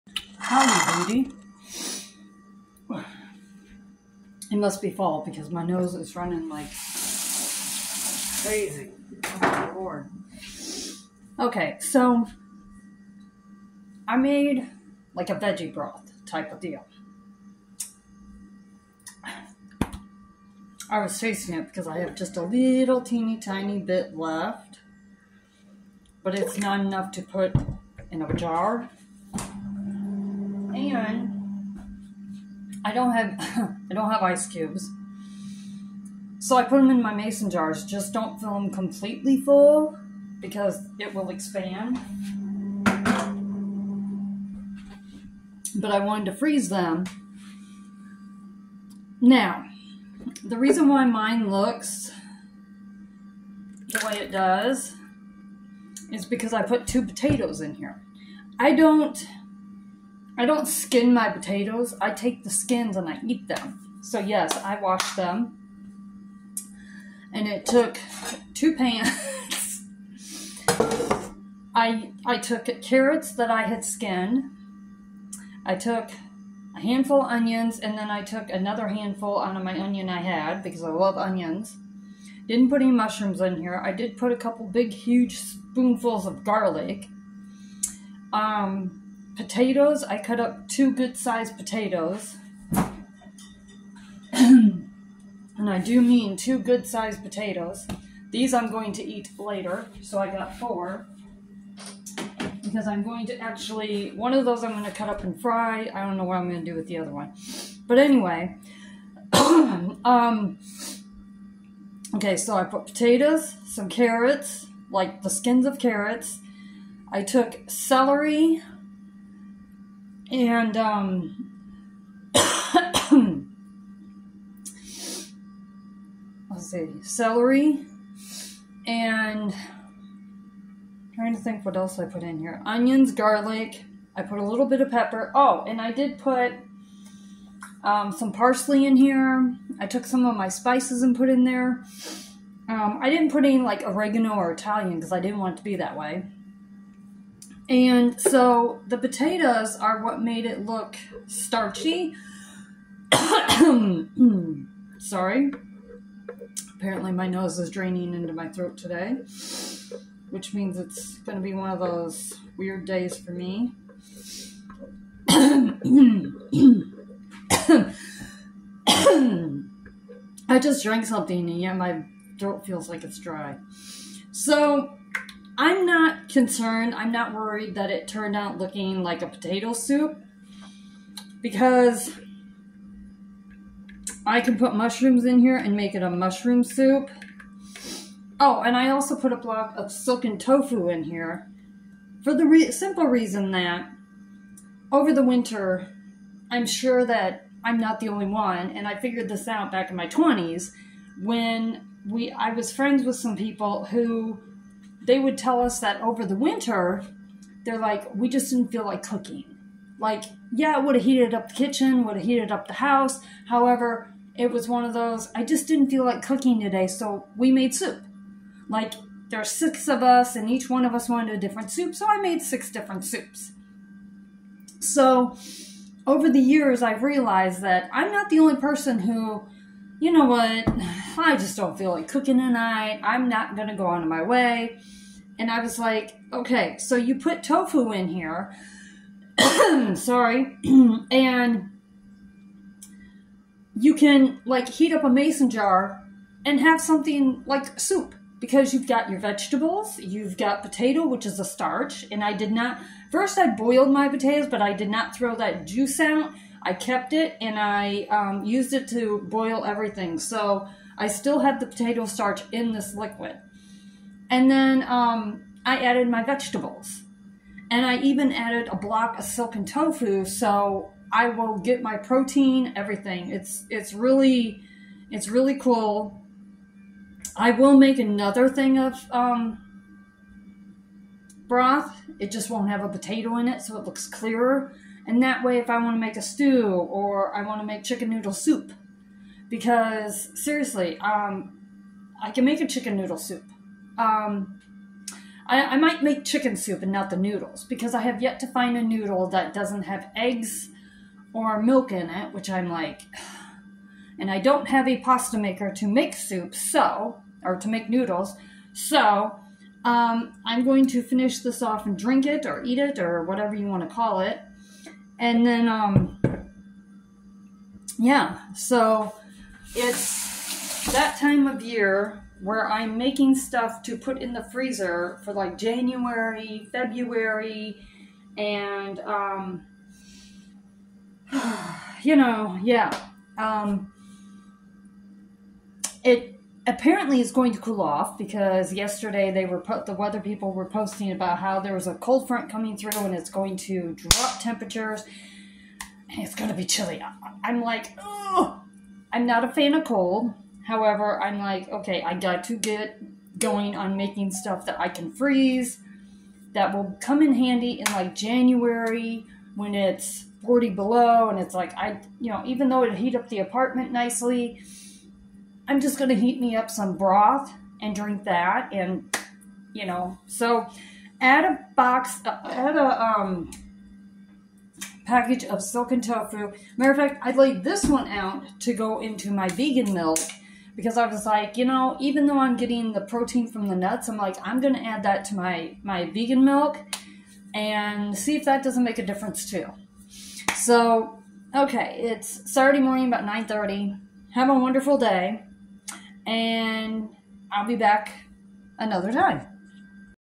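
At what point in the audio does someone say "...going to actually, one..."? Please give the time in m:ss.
1:43.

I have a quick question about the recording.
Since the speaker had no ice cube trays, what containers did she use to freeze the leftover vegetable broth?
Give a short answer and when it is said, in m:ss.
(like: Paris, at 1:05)
mason jars, at 0:37.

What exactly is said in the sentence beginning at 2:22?
Um, I didn't put any like oregano or Italian because I didn't want it to be that way.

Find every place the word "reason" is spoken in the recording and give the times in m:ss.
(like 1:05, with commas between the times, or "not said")
0:50, 3:13.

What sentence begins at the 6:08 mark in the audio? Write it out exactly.
And, you know, so add a box, add a um, package of silken tofu.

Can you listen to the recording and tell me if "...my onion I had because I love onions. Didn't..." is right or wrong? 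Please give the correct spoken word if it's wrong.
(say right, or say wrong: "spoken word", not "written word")
right.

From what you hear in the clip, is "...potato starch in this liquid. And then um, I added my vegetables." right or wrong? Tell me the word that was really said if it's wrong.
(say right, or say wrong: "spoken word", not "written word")
right.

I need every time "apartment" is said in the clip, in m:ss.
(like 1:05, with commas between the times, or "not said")
6:03.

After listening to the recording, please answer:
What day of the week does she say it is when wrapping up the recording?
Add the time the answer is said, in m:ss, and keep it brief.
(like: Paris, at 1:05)
Saturday, at 6:32.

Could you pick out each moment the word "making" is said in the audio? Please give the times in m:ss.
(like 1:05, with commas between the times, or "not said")
5:22, 5:53.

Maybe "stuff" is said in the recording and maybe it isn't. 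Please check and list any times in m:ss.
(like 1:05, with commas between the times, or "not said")
5:23, 5:54.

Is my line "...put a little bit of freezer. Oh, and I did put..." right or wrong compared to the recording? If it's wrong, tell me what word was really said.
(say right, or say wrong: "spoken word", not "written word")
wrong: "pepper", not "freezer".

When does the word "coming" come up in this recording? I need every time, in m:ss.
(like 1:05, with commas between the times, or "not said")
5:42.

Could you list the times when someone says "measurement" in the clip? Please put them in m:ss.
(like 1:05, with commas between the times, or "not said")
not said.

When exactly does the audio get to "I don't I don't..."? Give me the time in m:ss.
0:58.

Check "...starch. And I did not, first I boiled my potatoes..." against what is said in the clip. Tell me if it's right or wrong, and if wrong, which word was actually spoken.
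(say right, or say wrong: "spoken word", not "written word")
right.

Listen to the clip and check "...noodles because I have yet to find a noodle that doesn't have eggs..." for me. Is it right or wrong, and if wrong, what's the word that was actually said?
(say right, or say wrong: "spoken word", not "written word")
right.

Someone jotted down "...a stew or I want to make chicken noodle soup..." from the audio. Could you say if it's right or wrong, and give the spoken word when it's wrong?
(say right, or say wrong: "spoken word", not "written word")
right.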